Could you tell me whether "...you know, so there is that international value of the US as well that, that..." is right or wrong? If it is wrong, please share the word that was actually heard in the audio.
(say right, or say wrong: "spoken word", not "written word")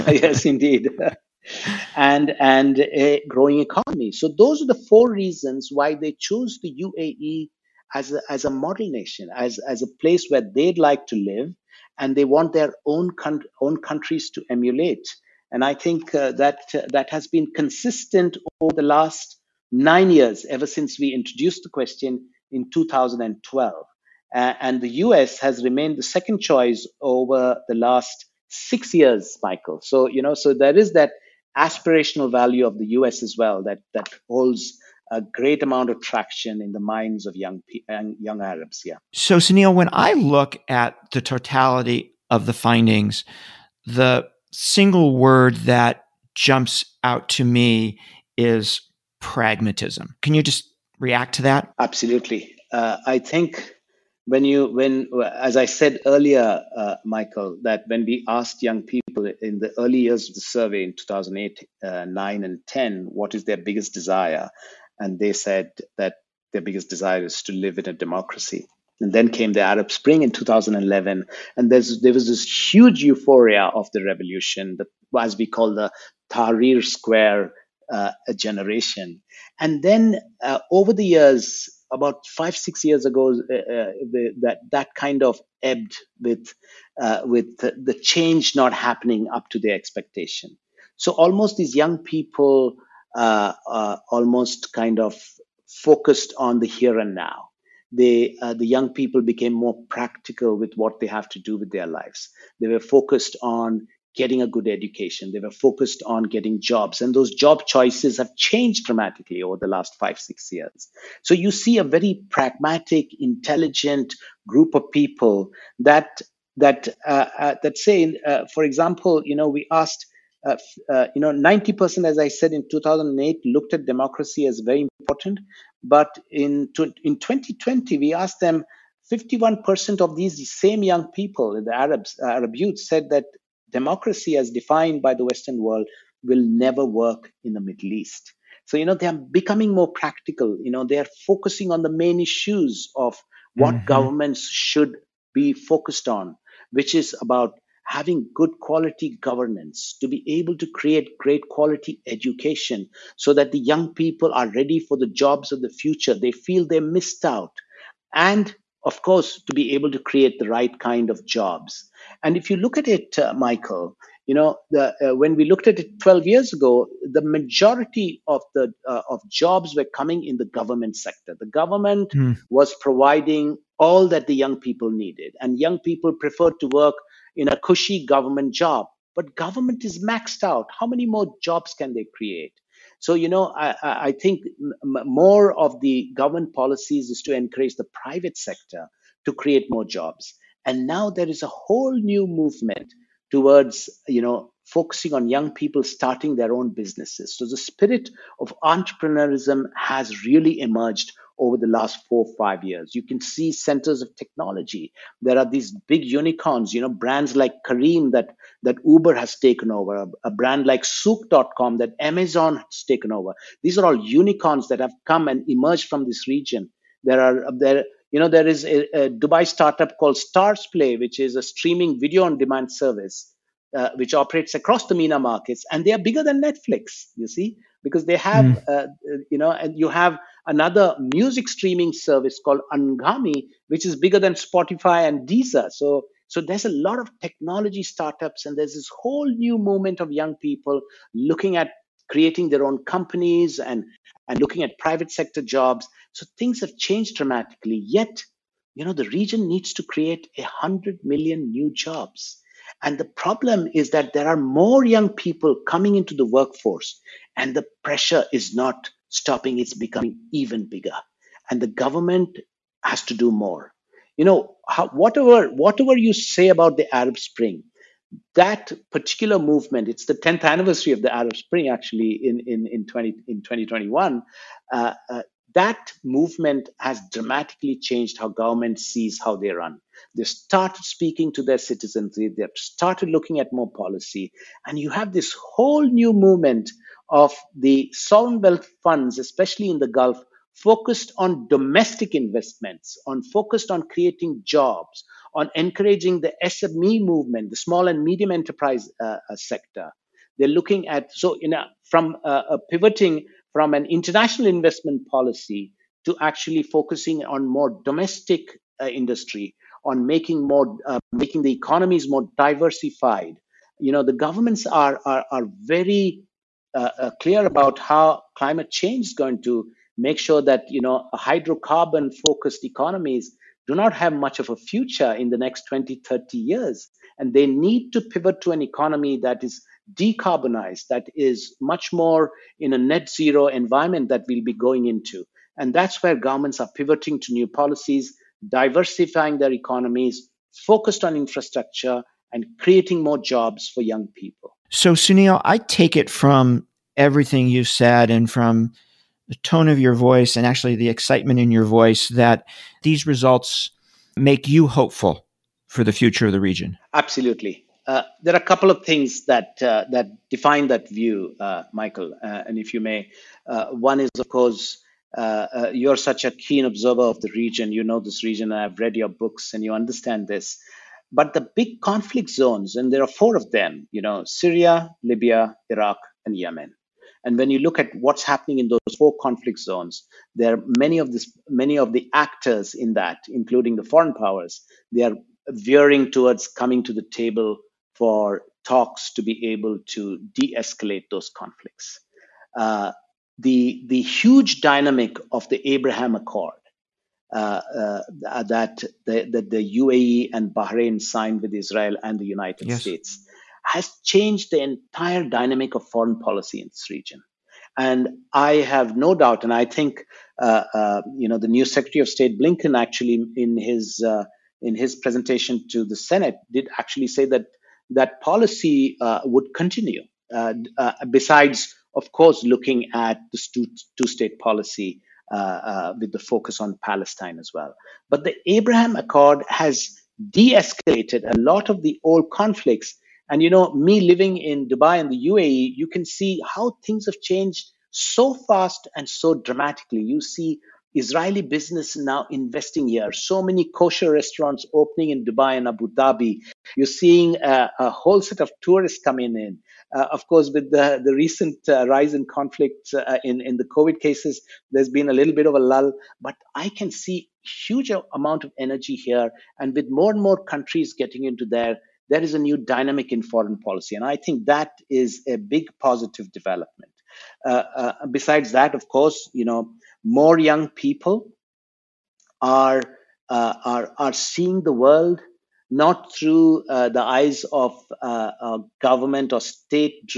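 wrong: "aspirational", not "international".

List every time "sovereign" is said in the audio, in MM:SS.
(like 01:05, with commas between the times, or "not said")
04:47.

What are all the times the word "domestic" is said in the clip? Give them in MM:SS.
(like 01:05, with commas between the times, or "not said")
04:51, 05:07.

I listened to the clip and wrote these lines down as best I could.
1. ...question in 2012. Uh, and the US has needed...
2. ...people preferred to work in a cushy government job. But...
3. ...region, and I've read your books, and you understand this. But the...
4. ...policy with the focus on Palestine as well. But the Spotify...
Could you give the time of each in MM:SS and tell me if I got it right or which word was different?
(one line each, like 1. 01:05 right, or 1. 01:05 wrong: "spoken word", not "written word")
1. 00:21 wrong: "remained", not "needed"
2. 02:55 right
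3. 06:08 right
4. 07:04 wrong: "Abraham", not "Spotify".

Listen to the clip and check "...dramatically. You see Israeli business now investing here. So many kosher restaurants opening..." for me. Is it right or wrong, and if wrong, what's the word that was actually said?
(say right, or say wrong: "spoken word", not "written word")
right.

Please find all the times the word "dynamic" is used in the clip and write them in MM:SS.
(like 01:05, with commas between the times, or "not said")
06:34, 06:45, 07:42.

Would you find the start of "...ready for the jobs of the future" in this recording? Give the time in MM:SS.
02:34.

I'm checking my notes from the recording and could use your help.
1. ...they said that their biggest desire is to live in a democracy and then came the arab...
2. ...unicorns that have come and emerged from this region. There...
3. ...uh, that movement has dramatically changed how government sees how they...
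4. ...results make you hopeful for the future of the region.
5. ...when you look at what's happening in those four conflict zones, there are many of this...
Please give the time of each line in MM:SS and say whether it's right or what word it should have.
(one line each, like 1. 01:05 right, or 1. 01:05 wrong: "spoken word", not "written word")
1. 01:05 right
2. 03:34 right
3. 04:35 right
4. 05:53 right
5. 06:17 right.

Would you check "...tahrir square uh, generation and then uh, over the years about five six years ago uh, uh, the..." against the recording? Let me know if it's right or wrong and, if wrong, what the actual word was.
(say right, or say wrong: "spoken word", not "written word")
right.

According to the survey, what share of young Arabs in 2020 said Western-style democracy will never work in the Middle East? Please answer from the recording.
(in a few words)
51%.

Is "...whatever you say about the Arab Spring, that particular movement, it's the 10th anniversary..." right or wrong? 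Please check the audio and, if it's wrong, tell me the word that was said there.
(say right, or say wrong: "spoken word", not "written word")
right.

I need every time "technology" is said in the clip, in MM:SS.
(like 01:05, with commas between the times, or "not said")
03:24, 03:57.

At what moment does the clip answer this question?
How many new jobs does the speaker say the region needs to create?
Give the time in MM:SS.
04:10.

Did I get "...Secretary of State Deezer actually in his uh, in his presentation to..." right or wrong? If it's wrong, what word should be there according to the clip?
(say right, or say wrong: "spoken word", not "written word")
wrong: "Blinken", not "Deezer".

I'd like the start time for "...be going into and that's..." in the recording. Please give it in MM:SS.
05:34.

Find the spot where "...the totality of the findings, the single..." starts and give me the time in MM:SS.
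00:41.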